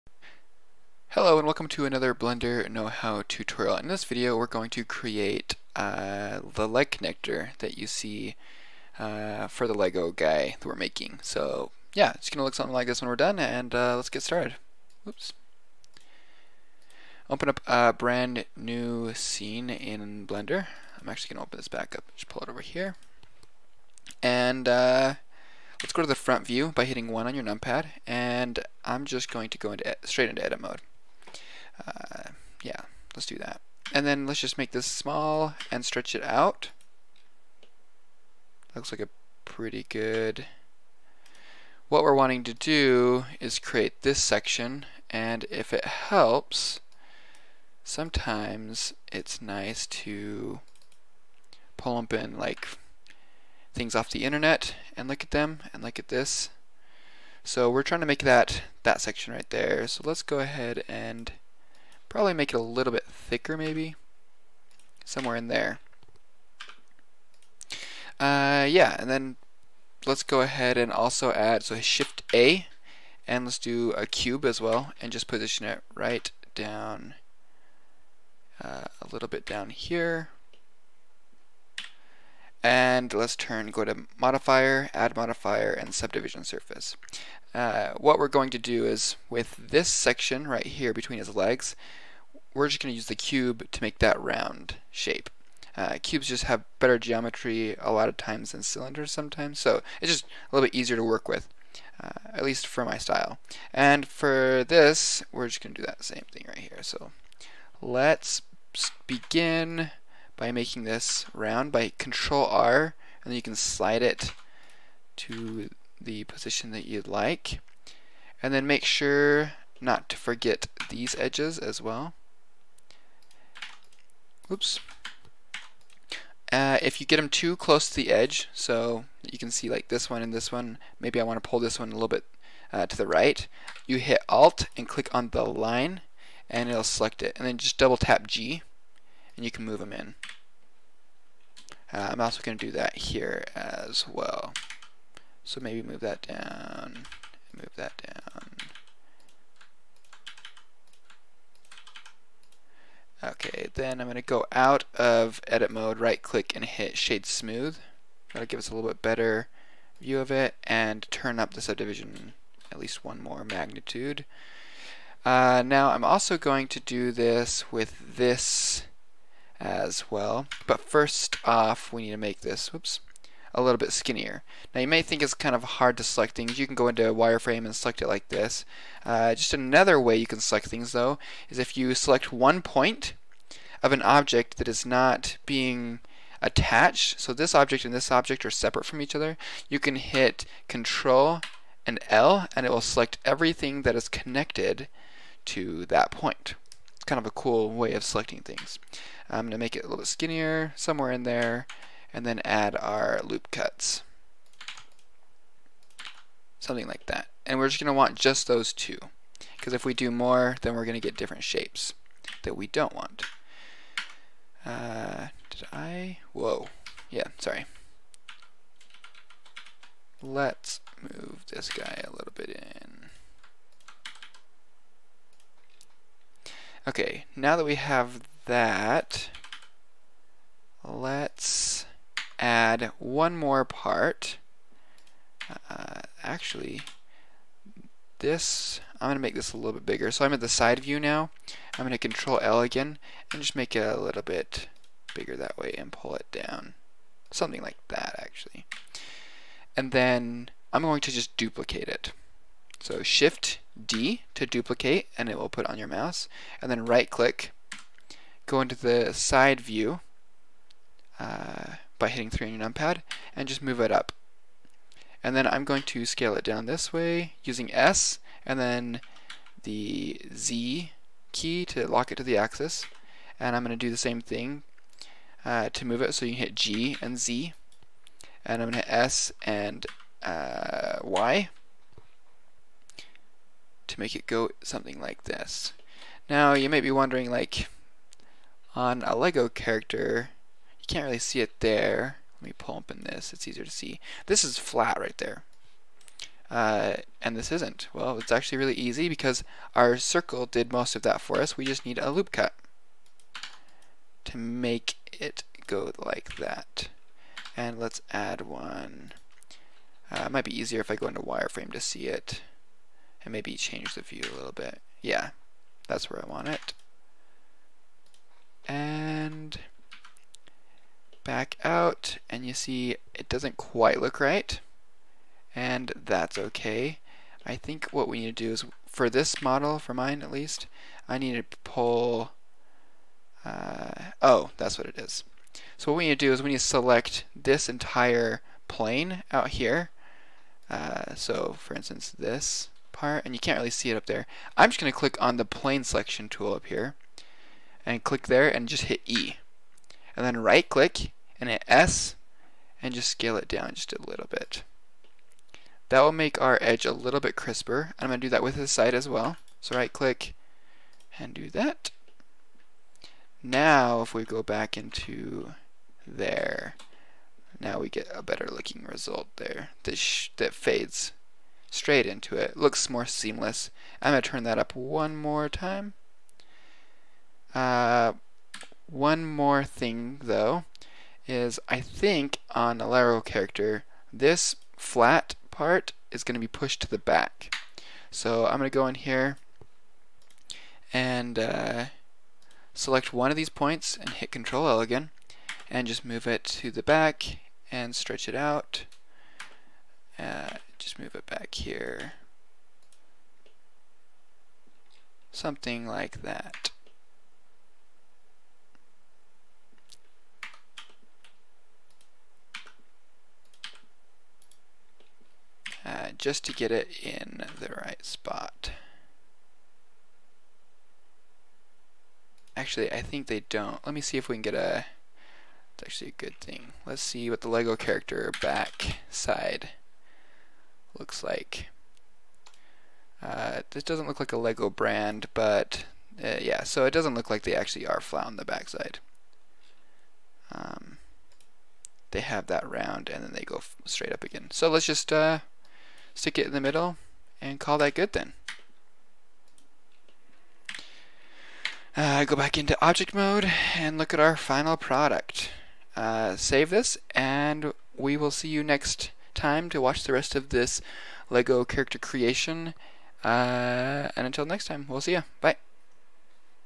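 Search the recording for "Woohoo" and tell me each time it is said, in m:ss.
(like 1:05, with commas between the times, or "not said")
not said.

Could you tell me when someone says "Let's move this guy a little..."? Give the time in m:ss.
3:40.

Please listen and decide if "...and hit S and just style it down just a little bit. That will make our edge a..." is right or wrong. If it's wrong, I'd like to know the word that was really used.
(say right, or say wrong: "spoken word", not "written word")
wrong: "scale", not "style".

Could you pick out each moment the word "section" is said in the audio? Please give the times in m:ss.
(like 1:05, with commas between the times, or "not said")
0:44, 0:59, 1:29.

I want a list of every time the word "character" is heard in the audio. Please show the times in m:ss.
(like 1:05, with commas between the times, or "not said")
4:49, 6:23, 7:07, 7:41.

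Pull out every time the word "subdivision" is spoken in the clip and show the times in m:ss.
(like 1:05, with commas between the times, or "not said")
1:25, 2:41.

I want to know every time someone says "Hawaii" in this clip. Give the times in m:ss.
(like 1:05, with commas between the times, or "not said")
not said.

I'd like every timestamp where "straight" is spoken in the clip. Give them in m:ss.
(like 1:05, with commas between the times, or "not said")
0:30, 6:11, 7:23.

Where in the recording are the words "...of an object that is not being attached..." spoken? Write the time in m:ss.
3:03.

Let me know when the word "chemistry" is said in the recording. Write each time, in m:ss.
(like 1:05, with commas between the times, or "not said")
not said.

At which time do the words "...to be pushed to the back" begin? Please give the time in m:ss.
6:26.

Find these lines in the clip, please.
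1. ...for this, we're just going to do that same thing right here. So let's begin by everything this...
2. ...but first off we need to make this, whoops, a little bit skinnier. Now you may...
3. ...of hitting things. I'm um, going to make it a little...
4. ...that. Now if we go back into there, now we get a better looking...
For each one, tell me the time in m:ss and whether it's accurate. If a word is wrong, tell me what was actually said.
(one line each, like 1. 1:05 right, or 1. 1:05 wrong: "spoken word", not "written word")
1. 1:44 wrong: "making", not "everything"
2. 2:50 right
3. 3:17 wrong: "selecting", not "hitting"
4. 6:01 right.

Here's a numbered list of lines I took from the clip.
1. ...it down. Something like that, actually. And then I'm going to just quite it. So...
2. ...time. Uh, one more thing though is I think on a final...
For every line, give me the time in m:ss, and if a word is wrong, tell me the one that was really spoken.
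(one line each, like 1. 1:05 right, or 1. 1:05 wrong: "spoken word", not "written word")
1. 4:06 wrong: "duplicate", not "quite"
2. 6:15 wrong: "lateral", not "final".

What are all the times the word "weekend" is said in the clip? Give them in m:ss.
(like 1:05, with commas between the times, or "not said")
not said.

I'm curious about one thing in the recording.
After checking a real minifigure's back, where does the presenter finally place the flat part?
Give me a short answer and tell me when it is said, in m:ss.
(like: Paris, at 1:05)
In the middle, at 7:26.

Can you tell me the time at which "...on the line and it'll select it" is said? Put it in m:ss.
2:15.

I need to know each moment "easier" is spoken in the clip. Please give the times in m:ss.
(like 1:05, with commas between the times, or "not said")
1:40, 4:53, 5:10.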